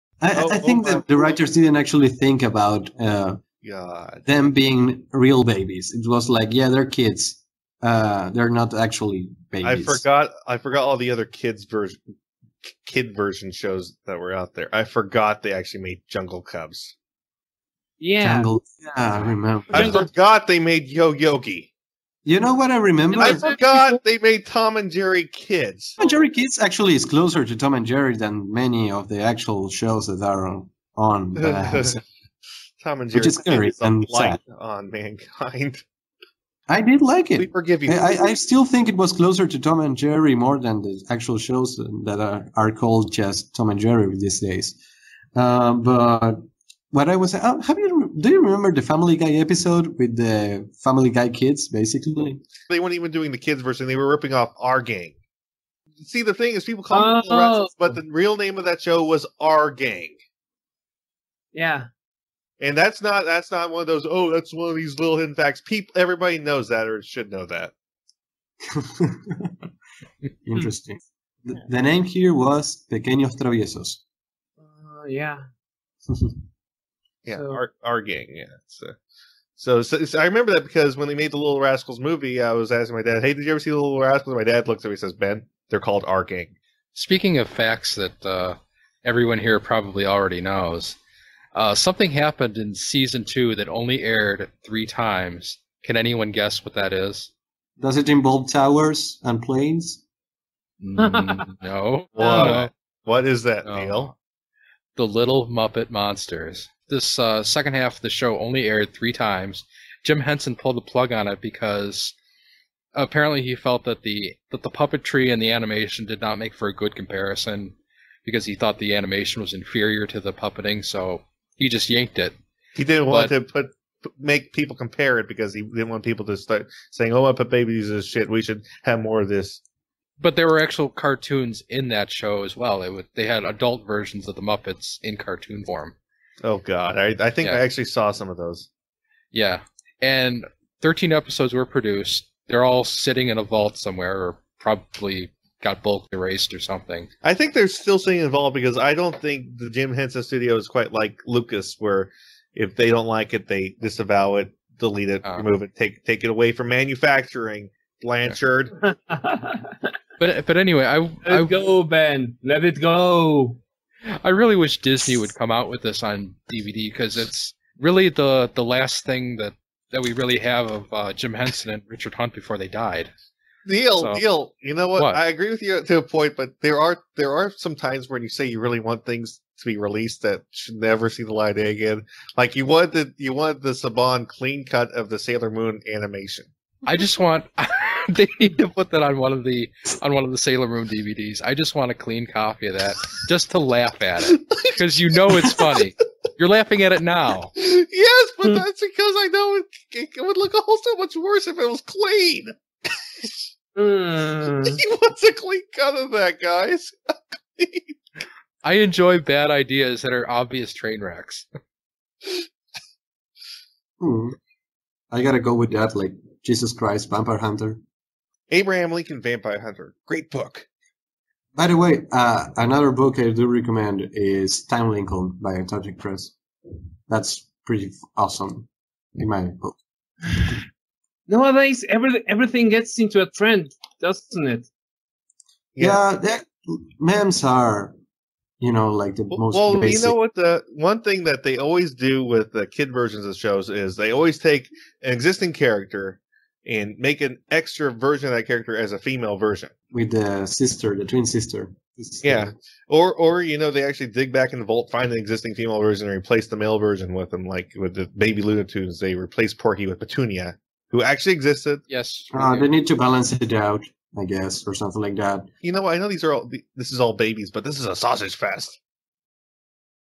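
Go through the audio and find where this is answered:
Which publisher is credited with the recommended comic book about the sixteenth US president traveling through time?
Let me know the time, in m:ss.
3:45.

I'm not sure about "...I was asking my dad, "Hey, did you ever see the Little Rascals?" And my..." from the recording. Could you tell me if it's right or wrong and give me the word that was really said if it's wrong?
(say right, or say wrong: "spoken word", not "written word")
right.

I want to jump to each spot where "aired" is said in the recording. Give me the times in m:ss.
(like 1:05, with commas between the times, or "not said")
1:34, 1:48.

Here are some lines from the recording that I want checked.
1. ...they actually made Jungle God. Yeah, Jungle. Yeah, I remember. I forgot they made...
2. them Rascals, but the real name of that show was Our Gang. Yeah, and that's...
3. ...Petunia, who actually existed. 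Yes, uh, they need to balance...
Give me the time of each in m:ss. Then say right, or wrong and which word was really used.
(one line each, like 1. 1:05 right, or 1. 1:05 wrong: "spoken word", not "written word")
1. 0:15 wrong: "Cubs", not "God"
2. 0:57 right
3. 4:19 right.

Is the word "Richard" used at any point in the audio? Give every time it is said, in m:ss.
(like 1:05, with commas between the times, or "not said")
2:51.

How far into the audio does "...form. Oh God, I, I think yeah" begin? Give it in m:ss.
2:15.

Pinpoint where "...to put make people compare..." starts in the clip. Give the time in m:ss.
2:03.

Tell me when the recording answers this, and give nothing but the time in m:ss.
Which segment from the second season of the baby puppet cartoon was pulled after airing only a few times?
1:44.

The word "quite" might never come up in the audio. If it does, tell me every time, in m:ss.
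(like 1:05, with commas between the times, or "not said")
2:30.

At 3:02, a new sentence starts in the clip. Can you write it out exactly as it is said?
Like you want the you want the Saban clean cut of the Sailor Moon animation.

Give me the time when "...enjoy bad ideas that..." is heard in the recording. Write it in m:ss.
3:28.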